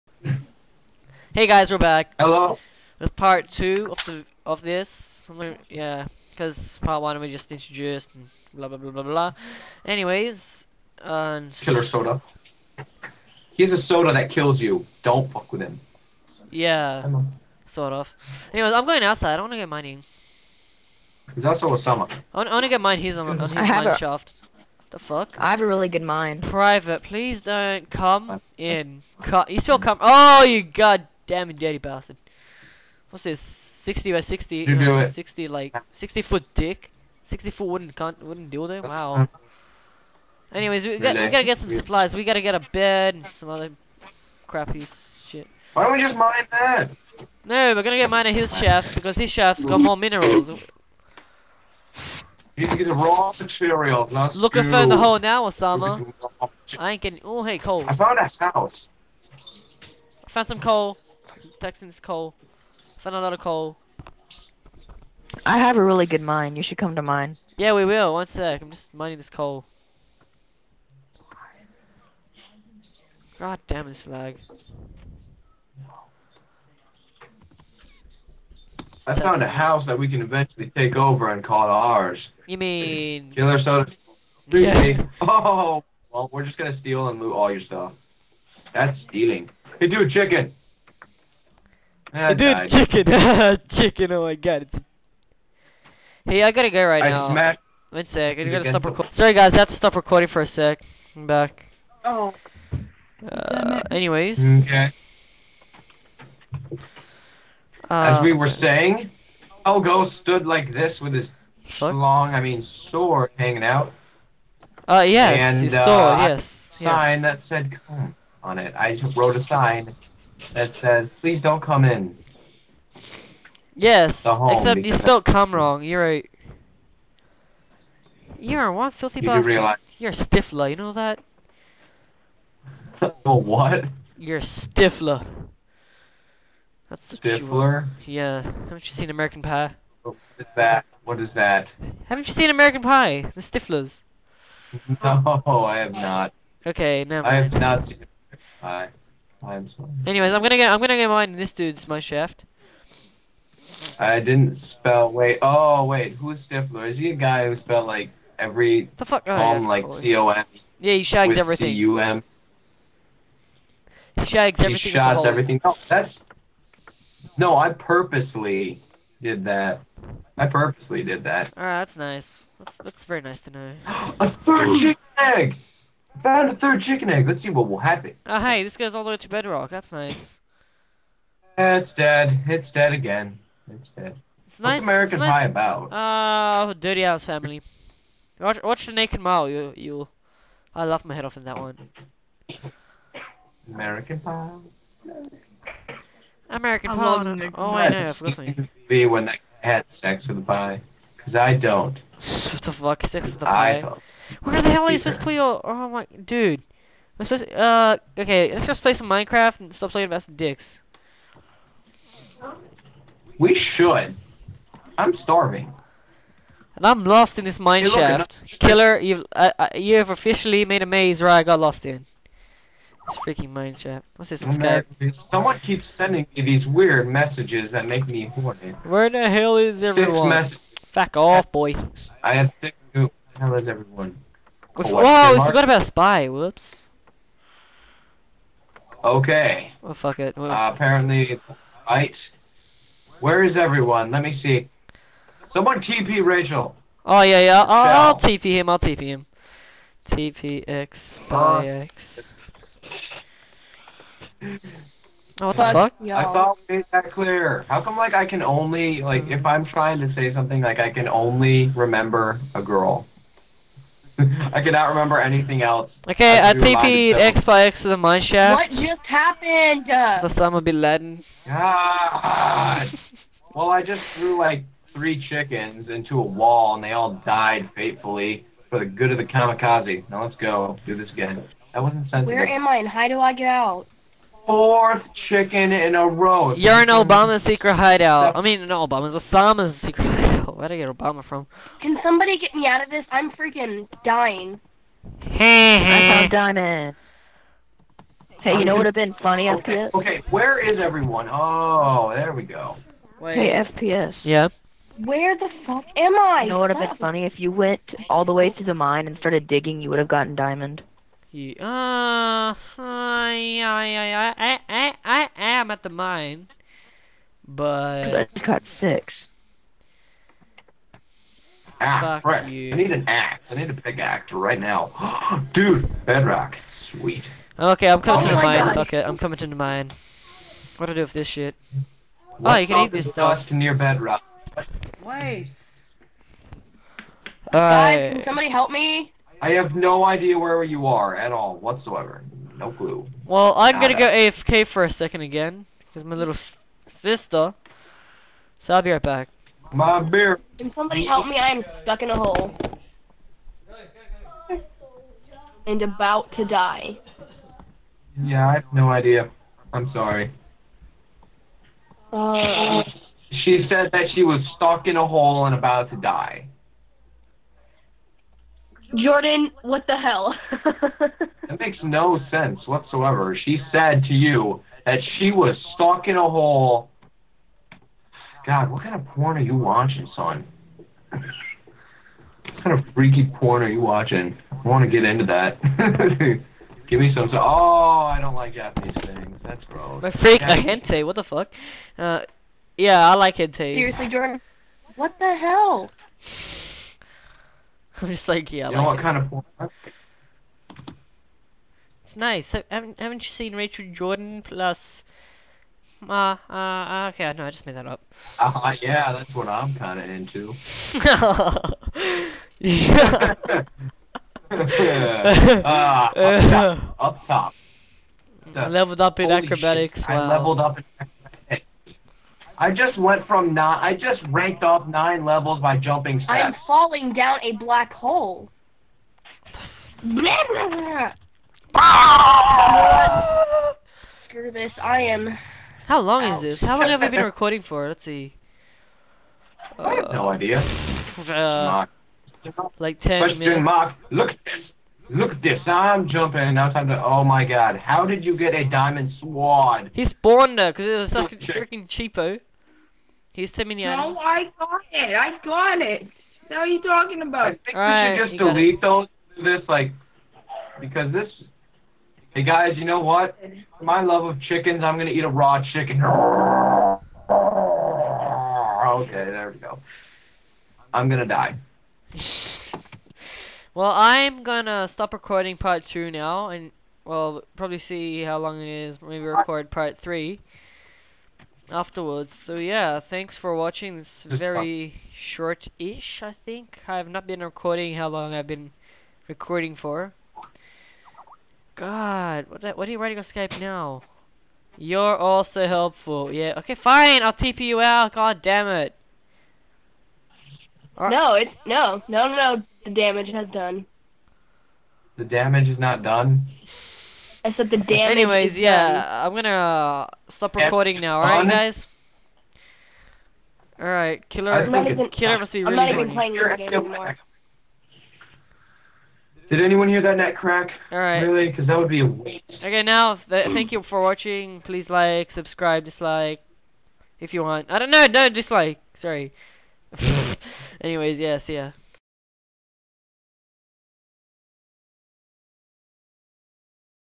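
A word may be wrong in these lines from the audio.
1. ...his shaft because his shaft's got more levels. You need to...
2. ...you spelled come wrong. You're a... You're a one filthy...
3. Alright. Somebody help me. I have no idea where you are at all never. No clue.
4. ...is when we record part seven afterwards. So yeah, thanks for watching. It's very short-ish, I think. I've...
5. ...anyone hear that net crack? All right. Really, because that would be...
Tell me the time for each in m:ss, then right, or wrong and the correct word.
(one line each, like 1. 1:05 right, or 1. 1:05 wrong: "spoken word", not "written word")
1. 0:48 wrong: "minerals", not "levels"
2. 2:04 right
3. 5:37 wrong: "whatsoever", not "never"
4. 7:58 wrong: "three", not "seven"
5. 8:39 right.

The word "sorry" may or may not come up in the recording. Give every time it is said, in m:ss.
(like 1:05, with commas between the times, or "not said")
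1:39, 2:29, 5:59, 8:48.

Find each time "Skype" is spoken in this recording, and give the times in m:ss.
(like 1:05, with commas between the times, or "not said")
3:44, 8:13.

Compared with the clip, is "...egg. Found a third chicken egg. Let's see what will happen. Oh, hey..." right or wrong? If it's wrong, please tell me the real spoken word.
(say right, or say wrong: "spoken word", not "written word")
right.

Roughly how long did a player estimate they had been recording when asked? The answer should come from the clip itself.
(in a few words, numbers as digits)
10 minutes.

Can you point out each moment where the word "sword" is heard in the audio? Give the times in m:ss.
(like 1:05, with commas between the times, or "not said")
1:52, 7:29.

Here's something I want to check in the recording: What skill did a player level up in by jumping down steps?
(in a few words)
Acrobatics.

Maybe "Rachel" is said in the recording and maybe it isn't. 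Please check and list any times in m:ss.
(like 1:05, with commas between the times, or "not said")
4:06, 6:43.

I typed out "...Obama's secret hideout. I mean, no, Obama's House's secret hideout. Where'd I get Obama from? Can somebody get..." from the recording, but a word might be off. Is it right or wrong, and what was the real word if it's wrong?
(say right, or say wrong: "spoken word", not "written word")
wrong: "Osama", not "House".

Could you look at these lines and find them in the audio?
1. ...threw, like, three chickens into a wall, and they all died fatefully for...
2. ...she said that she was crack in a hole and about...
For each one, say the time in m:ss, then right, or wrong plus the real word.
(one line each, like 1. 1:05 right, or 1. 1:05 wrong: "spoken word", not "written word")
1. 4:34 right
2. 6:03 wrong: "stuck", not "crack".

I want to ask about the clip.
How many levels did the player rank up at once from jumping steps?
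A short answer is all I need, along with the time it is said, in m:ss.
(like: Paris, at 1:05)
9, at 7:04.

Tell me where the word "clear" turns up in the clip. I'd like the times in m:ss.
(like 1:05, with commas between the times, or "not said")
4:17.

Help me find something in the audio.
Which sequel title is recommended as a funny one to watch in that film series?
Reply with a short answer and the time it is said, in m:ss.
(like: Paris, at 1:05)
The Naked Mile, at 3:08.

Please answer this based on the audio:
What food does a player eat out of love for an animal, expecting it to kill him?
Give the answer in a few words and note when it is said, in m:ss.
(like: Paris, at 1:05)
Raw chicken, at 7:45.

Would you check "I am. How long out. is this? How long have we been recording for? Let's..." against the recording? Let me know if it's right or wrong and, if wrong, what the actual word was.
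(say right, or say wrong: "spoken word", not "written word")
right.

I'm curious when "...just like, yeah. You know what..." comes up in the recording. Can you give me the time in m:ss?
6:38.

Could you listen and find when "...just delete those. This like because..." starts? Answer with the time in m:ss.
7:38.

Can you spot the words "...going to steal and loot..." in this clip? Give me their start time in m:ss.
1:26.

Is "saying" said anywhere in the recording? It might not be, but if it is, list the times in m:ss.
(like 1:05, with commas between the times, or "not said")
1:48.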